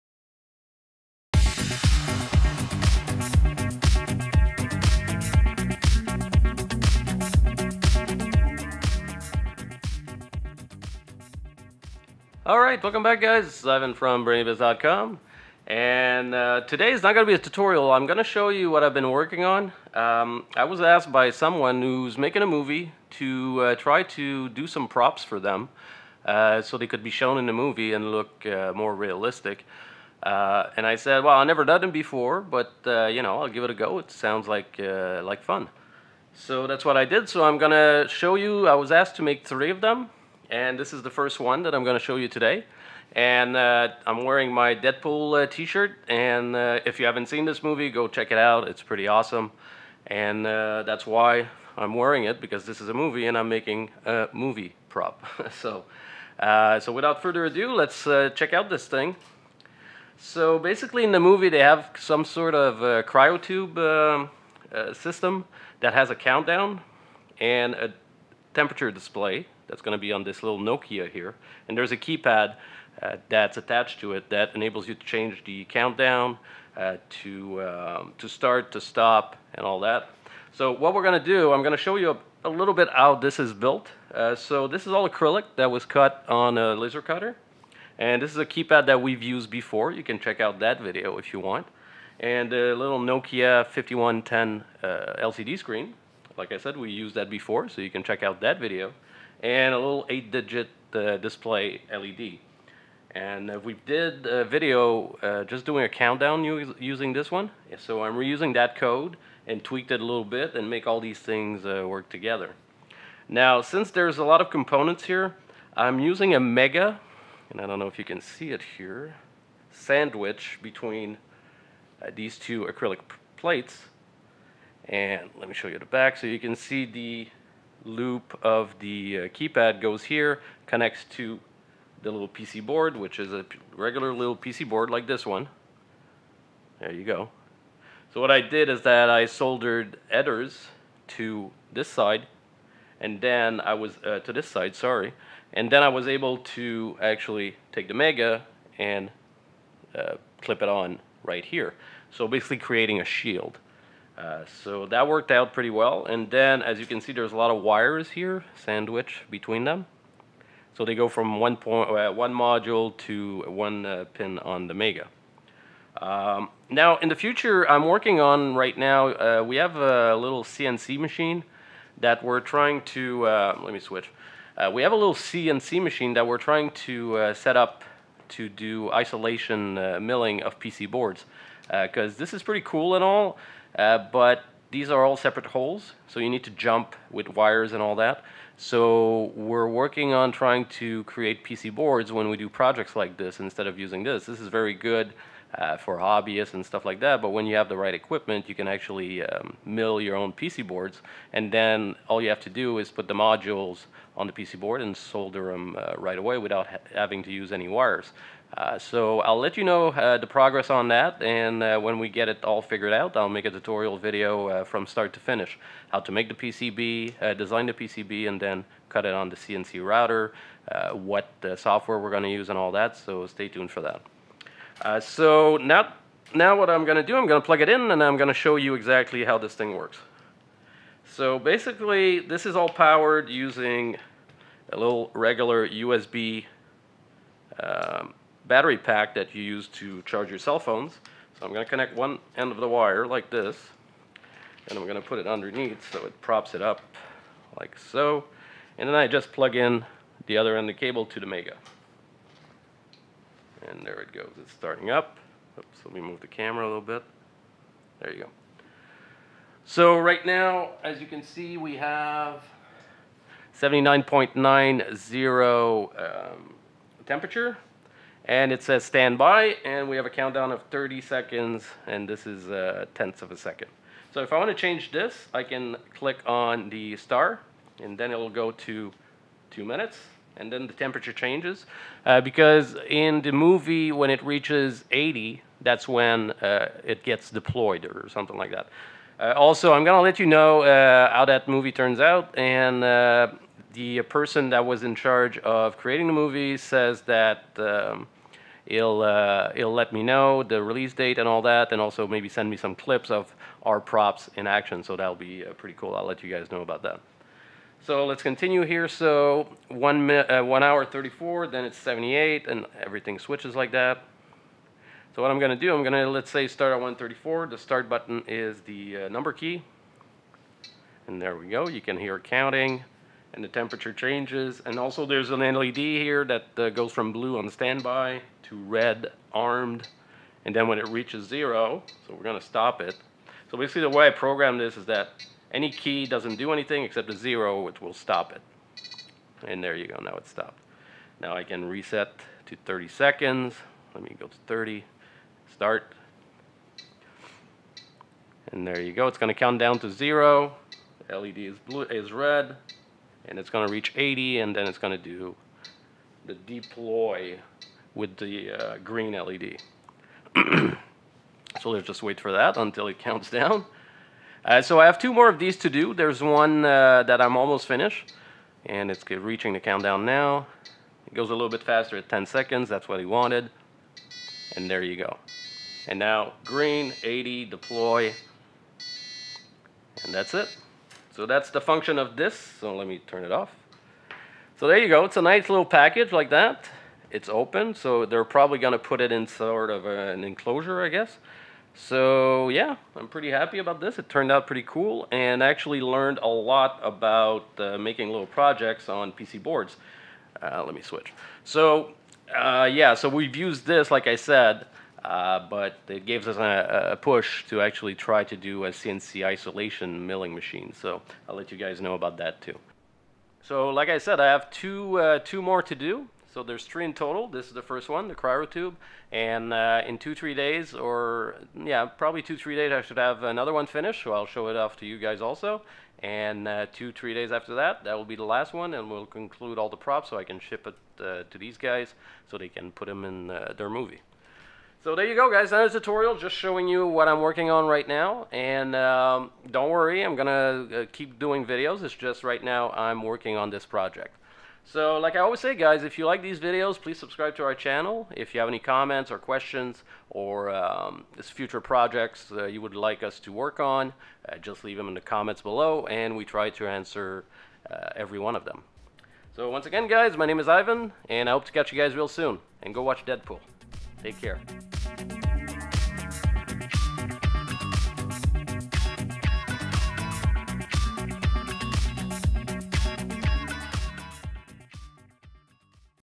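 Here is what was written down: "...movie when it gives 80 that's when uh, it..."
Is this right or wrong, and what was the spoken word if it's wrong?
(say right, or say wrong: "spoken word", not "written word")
wrong: "reaches", not "gives".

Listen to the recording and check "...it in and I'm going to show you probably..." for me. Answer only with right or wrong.
wrong.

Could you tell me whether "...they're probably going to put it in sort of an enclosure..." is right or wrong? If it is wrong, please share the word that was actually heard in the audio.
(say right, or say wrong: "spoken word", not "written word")
right.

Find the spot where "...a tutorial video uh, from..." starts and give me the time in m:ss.
3:33.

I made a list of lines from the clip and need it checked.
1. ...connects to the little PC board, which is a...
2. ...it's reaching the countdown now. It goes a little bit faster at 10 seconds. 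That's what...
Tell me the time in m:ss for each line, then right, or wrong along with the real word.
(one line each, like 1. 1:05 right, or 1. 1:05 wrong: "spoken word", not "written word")
1. 2:10 right
2. 6:08 right.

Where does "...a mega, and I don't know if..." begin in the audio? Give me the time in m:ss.
1:56.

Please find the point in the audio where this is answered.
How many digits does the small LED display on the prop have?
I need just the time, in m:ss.
1:40.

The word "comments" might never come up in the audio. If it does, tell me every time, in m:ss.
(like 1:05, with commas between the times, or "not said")
7:28, 7:35.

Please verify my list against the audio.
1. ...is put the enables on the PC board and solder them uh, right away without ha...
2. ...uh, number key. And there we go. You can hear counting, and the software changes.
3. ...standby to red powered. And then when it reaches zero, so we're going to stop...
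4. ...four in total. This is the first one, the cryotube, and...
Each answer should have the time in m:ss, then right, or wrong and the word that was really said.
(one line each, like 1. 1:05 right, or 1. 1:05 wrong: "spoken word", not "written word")
1. 3:22 wrong: "modules", not "enables"
2. 5:19 wrong: "temperature", not "software"
3. 5:27 wrong: "armed", not "powered"
4. 6:56 wrong: "three", not "four".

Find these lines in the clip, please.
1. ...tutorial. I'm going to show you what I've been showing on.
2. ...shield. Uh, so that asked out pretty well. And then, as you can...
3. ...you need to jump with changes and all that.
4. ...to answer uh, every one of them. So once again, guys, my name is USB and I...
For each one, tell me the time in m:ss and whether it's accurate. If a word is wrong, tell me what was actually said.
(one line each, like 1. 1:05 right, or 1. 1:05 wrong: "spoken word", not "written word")
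1. 0:17 wrong: "working", not "showing"
2. 2:33 wrong: "worked", not "asked"
3. 3:06 wrong: "wires", not "changes"
4. 7:36 wrong: "Ivan", not "USB".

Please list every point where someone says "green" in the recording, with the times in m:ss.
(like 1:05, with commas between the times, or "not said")
5:58, 6:16.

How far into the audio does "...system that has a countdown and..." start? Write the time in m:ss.
1:04.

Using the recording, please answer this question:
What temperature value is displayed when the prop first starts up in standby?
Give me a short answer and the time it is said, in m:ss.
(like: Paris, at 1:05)
79.90, at 4:23.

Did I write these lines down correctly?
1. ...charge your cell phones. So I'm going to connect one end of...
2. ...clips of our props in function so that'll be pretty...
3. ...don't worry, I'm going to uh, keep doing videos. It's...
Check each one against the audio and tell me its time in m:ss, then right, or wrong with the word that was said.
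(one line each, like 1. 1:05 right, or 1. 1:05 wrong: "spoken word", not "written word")
1. 4:00 right
2. 5:02 wrong: "action", not "function"
3. 7:19 right.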